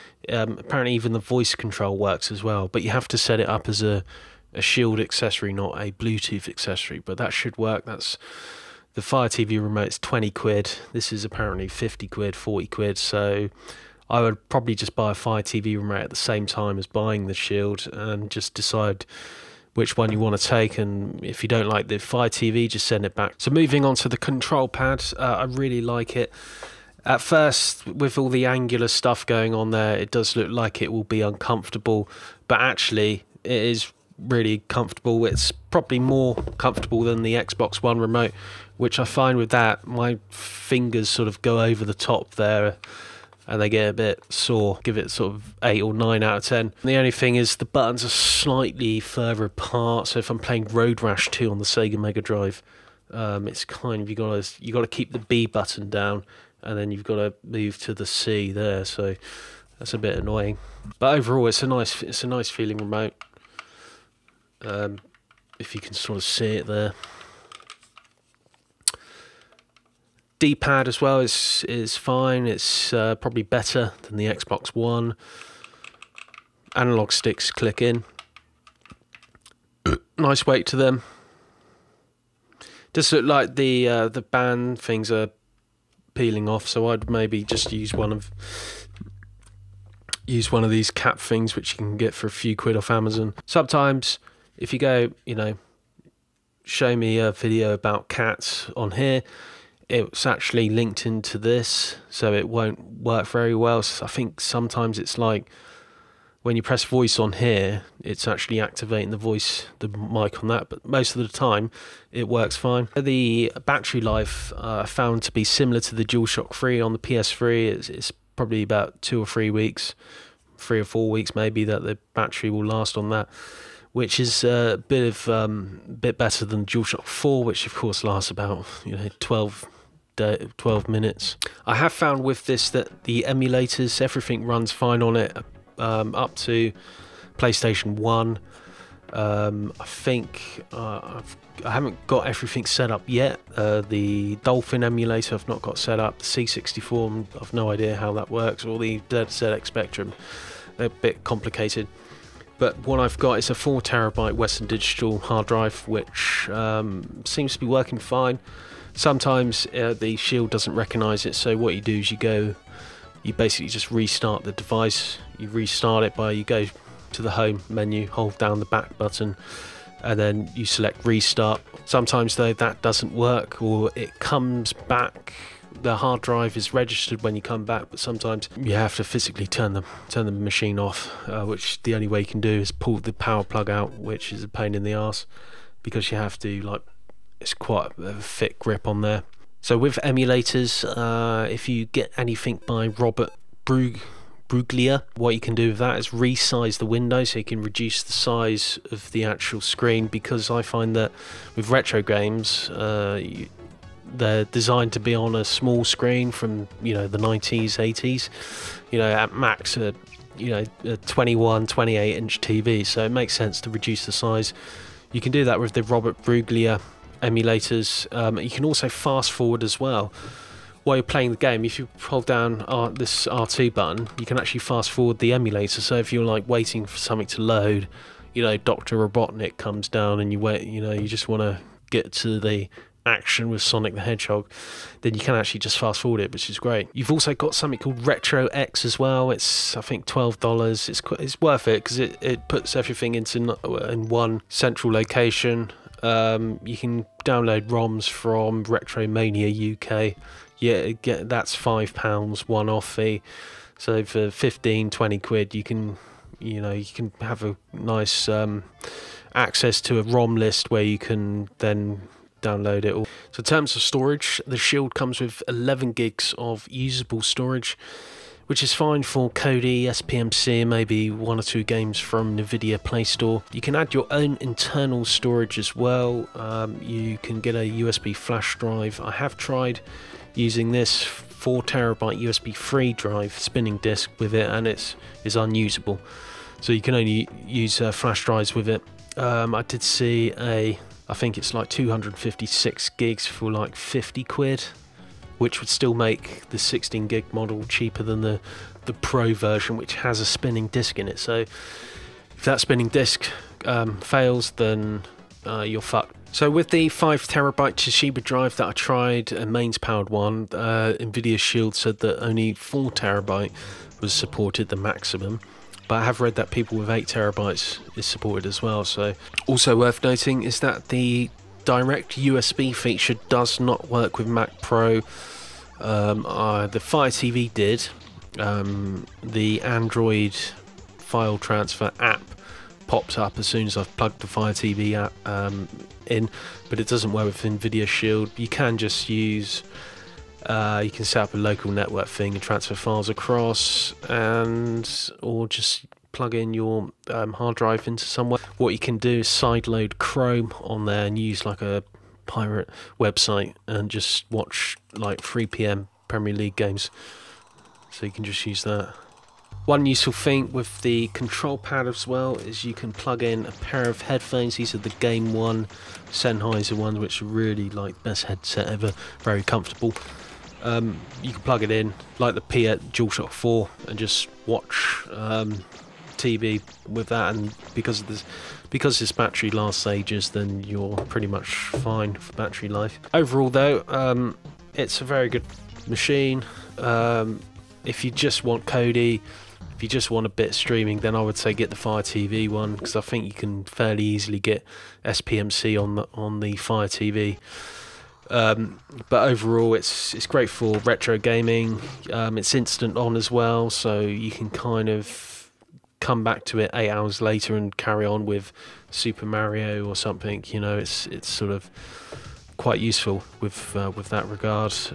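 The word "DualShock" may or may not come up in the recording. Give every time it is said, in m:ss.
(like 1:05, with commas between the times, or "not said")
1:56, 2:06, 6:12.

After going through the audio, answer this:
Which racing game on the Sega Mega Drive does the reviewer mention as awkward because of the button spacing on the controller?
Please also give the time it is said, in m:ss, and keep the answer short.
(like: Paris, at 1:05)
Road Rash 2, at 0:50.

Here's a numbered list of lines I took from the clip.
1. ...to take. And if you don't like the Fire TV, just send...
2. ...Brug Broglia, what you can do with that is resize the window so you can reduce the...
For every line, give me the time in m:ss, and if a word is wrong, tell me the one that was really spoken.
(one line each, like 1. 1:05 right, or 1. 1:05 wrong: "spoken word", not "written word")
1. 0:20 right
2. 3:13 right.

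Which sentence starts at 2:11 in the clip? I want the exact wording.
I have found with this that the emulators, everything runs fine on it um, up to PlayStation 1.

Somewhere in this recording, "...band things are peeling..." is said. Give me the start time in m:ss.
1:24.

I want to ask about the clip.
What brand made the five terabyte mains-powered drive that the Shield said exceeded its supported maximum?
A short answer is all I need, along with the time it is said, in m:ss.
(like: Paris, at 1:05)
Toshiba, at 5:07.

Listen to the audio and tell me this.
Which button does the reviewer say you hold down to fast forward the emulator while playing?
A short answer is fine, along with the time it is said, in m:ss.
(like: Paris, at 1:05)
R2, at 3:43.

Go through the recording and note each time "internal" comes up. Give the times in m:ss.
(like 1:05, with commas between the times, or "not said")
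4:34.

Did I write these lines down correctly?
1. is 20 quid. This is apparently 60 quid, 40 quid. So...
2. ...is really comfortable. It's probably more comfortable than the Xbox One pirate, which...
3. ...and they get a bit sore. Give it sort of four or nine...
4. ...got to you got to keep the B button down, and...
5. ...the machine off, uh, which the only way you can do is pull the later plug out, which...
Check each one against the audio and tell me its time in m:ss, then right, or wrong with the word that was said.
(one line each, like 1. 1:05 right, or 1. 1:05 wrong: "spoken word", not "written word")
1. 0:09 wrong: "50", not "60"
2. 0:33 wrong: "remote", not "pirate"
3. 0:43 wrong: "eight", not "four"
4. 0:54 right
5. 3:00 wrong: "power", not "later".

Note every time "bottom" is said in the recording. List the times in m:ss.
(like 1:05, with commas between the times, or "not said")
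not said.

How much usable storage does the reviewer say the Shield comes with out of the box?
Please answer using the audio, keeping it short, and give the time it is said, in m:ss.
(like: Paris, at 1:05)
11 gigs, at 4:25.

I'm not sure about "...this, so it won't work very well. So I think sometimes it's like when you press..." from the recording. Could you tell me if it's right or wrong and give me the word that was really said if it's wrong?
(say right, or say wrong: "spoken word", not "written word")
right.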